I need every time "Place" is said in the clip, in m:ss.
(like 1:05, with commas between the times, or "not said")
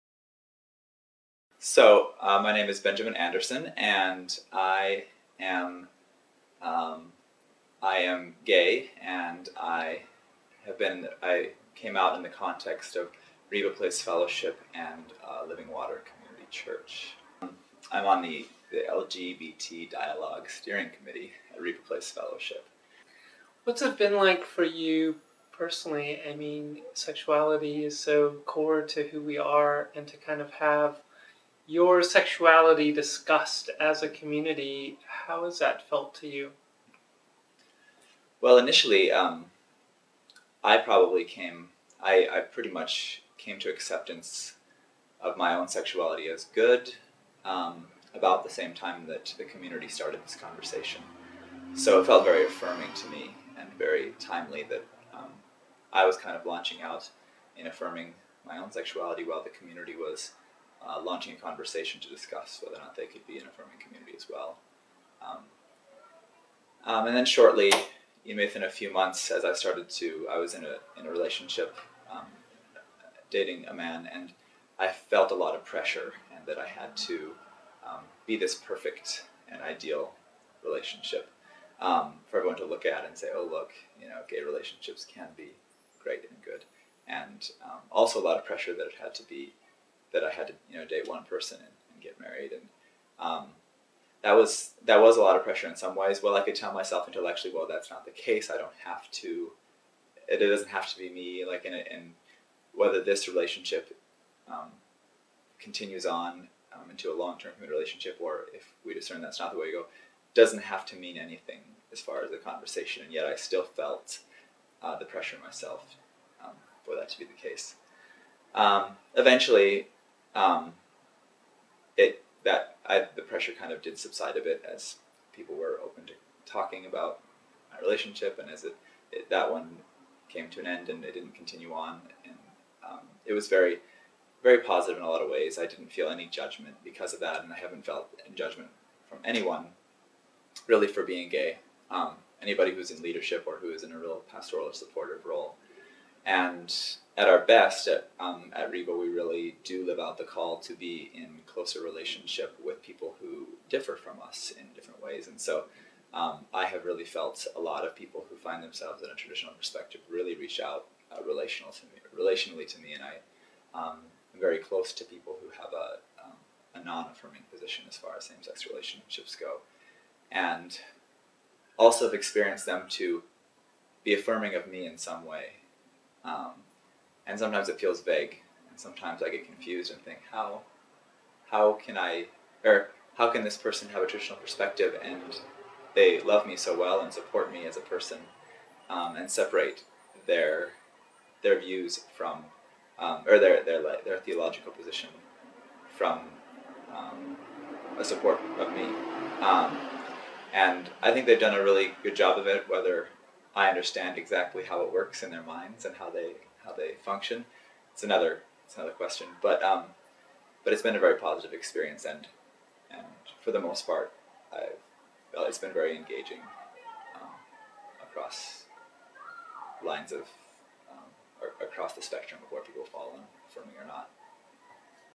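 0:13, 0:21.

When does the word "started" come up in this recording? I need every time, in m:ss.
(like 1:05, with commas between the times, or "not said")
0:49, 1:09.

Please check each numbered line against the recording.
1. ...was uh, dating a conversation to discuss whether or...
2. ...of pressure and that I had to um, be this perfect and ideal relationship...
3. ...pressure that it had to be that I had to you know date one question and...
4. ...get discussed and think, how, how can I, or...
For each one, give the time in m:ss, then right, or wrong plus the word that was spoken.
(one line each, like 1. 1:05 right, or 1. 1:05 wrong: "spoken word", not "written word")
1. 0:59 wrong: "launching", not "dating"
2. 1:15 right
3. 1:28 wrong: "person", not "question"
4. 2:59 wrong: "confused", not "discussed".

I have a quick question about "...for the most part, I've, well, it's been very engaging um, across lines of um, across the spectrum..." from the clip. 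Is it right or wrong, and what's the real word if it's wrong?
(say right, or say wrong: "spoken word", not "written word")
right.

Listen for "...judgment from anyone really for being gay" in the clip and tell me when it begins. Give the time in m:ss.
2:18.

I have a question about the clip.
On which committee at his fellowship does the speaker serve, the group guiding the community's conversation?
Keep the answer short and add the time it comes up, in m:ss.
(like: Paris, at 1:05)
LGBT Dialogue Steering Committee, at 0:18.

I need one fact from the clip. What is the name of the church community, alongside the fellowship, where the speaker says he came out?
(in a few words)
Living Water Community Church.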